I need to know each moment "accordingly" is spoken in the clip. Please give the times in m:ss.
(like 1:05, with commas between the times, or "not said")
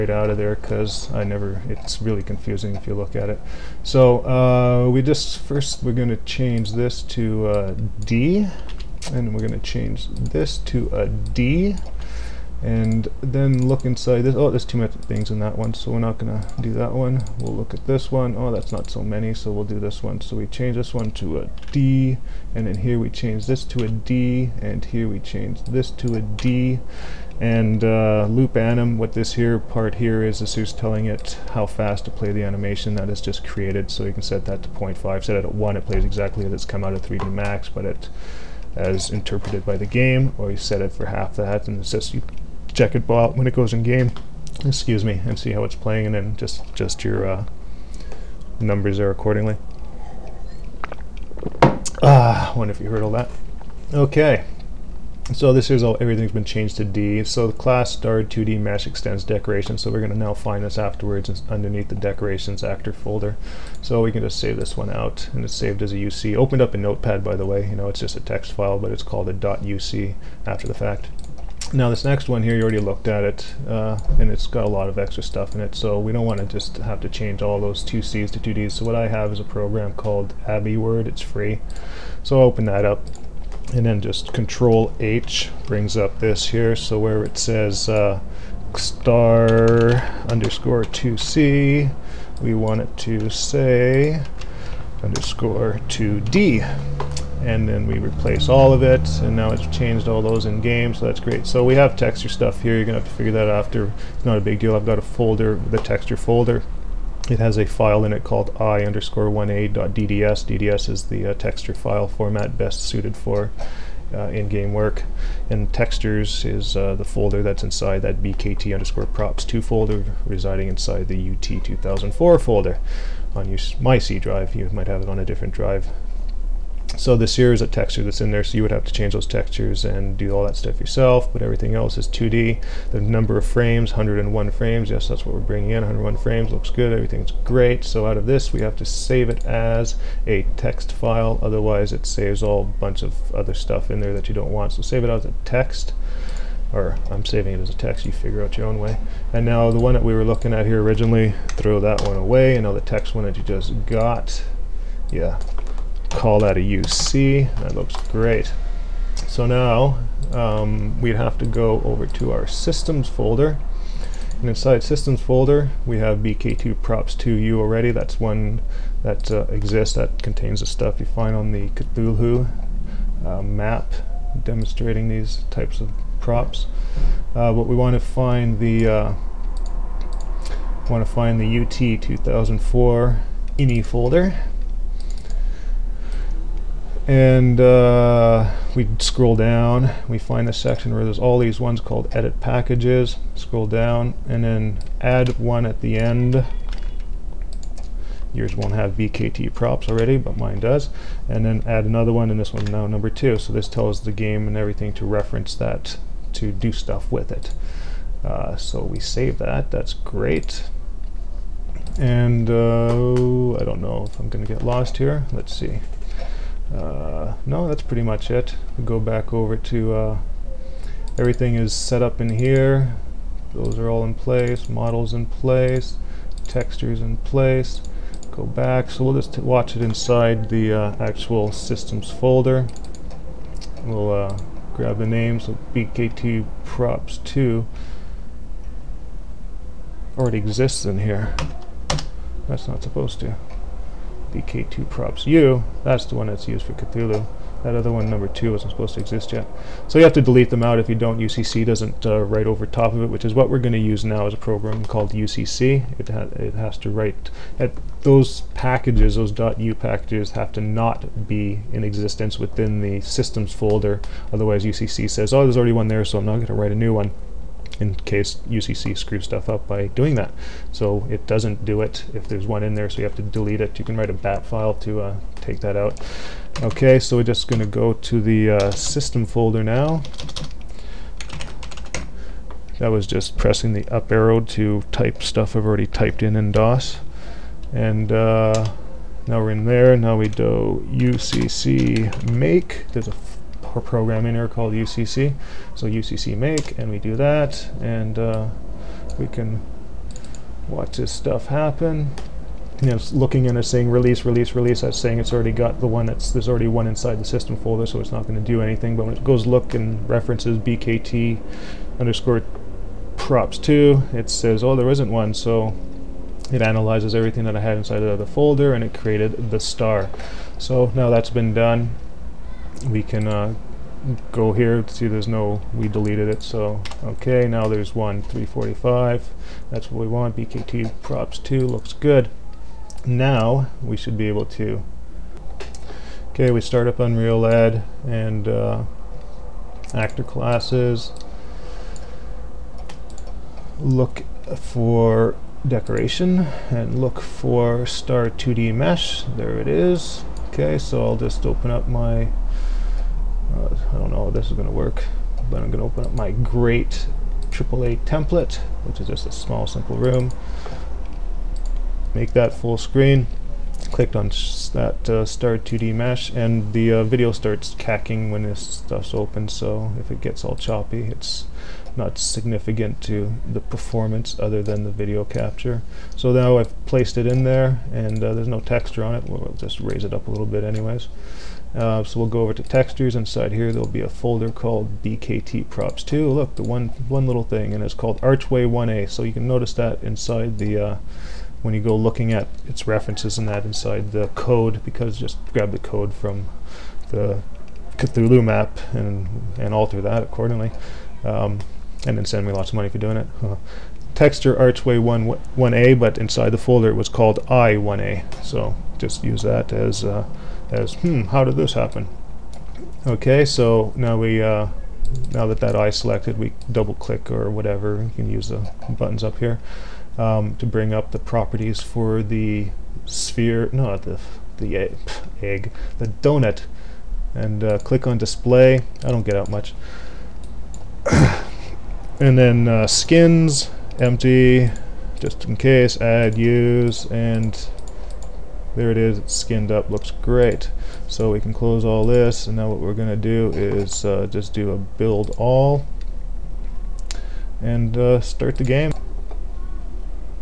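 0:49, 6:40.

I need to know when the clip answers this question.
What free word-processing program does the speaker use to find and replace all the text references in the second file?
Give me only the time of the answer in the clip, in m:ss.
1:20.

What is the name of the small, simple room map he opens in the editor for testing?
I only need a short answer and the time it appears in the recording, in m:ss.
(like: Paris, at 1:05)
great AAA template, at 5:56.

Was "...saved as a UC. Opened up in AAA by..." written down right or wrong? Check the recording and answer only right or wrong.
wrong.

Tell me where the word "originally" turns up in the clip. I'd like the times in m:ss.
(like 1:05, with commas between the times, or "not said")
2:30.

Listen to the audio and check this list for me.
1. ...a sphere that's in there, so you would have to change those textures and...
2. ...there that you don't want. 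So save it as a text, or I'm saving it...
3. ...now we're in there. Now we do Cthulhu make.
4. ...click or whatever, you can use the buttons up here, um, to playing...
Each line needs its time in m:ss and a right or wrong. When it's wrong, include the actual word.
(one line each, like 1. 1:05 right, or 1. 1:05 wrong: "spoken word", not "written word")
1. 2:07 wrong: "texture", not "sphere"
2. 2:23 right
3. 4:49 wrong: "UCC", not "Cthulhu"
4. 6:56 wrong: "bring", not "playing".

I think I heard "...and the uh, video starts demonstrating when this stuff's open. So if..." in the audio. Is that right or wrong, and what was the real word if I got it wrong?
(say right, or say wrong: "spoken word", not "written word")
wrong: "cacking", not "demonstrating".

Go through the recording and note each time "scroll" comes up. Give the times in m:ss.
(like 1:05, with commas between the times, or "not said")
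3:08, 3:13.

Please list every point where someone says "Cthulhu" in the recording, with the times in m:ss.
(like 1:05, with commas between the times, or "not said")
2:51, 4:06, 6:37.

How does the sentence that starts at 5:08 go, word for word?
But when it goes look and references bkt underscore props two, it says, oh, there isn't one.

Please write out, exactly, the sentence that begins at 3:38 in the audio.
We'll go back over to uh, everything is set up in here.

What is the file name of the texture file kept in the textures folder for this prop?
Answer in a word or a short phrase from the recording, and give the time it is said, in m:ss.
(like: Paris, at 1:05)
i_1a.dds, at 1:48.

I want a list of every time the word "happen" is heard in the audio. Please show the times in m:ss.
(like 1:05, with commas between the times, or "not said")
5:01, 6:51.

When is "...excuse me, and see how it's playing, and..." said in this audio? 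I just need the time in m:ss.
0:44.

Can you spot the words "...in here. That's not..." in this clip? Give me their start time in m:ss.
4:00.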